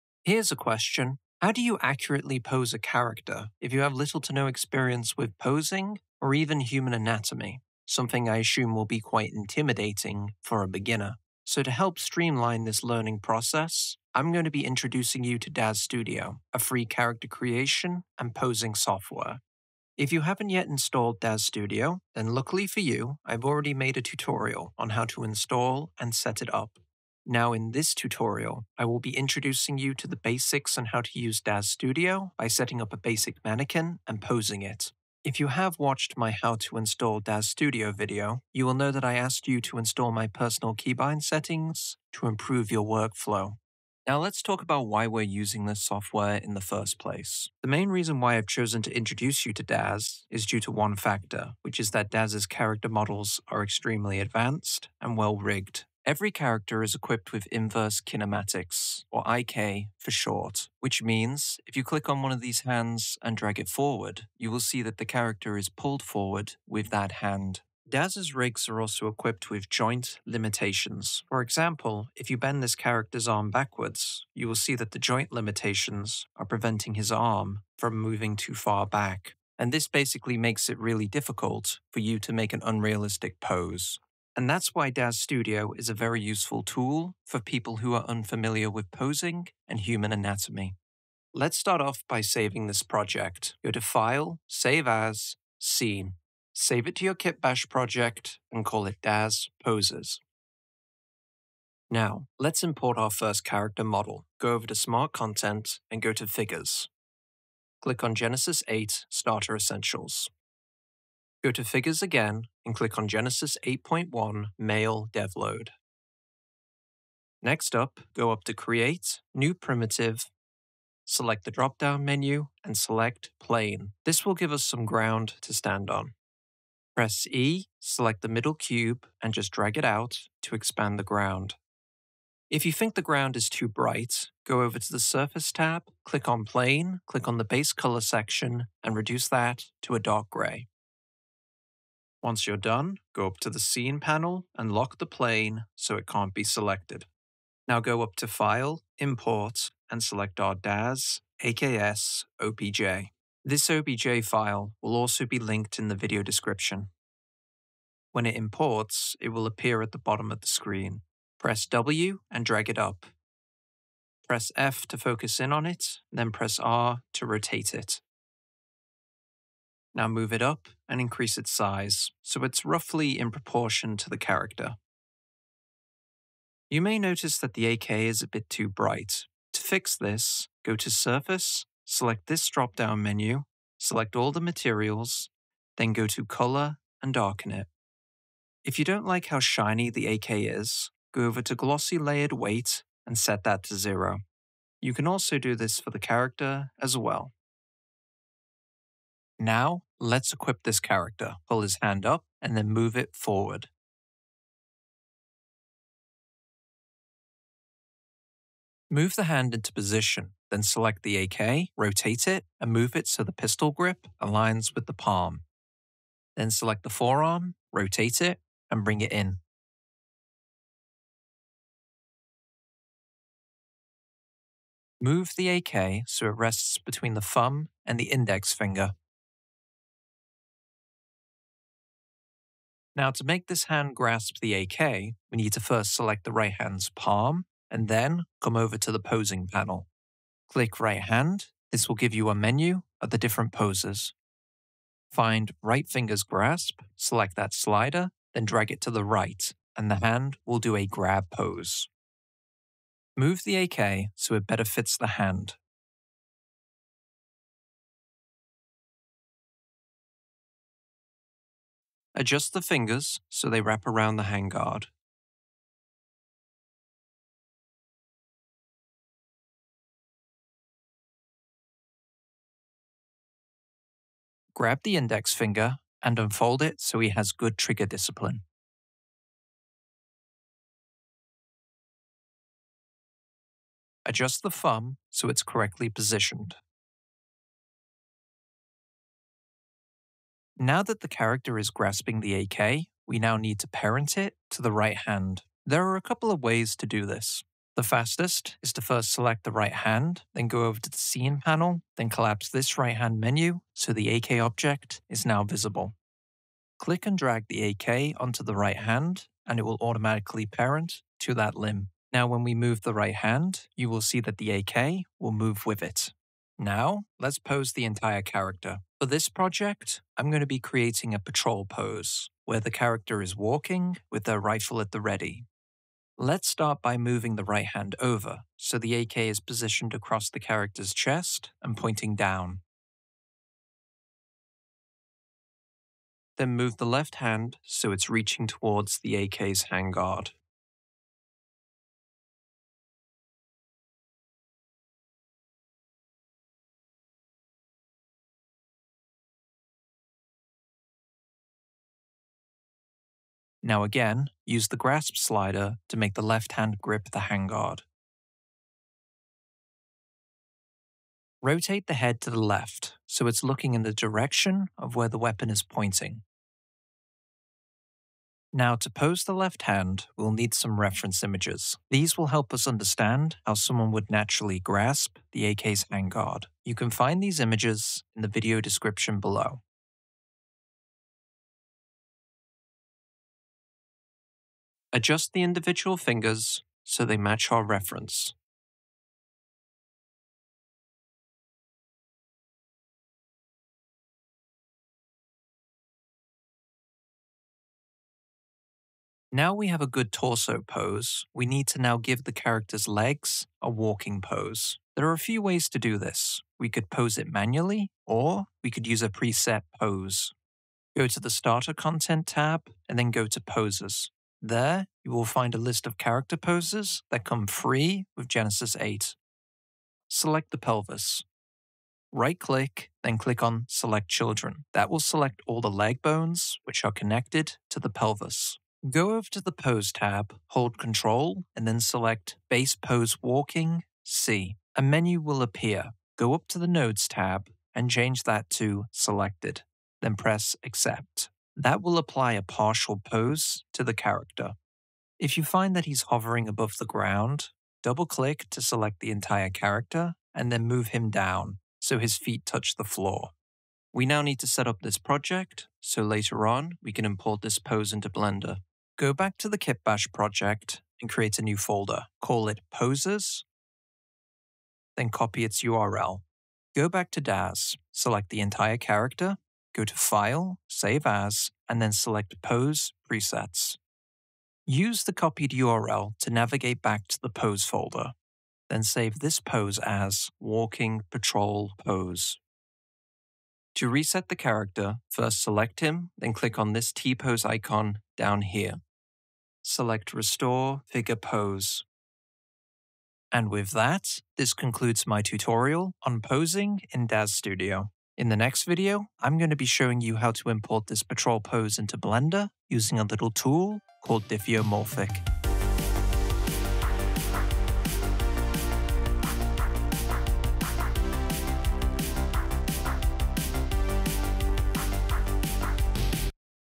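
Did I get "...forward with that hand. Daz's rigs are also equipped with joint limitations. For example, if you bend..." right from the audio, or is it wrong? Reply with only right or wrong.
right.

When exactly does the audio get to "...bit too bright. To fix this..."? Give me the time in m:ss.
2:58.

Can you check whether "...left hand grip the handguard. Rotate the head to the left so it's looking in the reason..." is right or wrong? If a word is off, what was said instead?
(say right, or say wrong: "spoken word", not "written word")
wrong: "direction", not "reason".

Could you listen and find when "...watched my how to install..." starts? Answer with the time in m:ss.
0:35.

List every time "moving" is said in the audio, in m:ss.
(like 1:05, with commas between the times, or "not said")
1:18, 5:26.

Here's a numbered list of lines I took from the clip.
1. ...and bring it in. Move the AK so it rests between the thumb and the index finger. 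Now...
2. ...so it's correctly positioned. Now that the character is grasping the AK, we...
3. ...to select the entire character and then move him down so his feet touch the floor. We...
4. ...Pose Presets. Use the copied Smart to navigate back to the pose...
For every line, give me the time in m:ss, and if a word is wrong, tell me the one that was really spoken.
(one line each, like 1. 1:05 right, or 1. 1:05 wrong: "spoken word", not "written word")
1. 3:38 right
2. 4:45 right
3. 7:28 right
4. 7:52 wrong: "URL", not "Smart".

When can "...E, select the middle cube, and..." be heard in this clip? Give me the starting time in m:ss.
2:07.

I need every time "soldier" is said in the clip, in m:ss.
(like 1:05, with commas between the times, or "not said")
not said.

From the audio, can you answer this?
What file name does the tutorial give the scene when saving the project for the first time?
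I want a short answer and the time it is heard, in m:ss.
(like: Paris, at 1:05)
DAZ Poses, at 1:39.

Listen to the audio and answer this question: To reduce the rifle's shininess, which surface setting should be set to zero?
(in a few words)
Glossy Layered Weight.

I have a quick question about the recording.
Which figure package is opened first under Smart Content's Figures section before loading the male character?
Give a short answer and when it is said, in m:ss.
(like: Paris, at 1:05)
Genesis 8 Starter Essentials, at 1:48.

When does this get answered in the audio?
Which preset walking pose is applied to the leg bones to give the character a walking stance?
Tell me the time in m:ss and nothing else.
7:12.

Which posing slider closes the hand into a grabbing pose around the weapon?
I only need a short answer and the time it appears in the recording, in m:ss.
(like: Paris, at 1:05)
right finger's grasp, at 4:05.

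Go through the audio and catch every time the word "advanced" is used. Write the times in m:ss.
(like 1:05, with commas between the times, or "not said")
0:54.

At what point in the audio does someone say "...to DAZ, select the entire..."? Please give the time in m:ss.
7:47.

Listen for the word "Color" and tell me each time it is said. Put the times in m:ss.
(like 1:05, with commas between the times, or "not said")
2:17, 3:06.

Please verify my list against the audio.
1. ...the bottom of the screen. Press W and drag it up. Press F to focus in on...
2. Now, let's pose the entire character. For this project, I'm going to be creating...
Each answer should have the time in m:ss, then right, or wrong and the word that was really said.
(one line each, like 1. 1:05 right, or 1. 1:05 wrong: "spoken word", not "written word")
1. 2:39 right
2. 5:16 right.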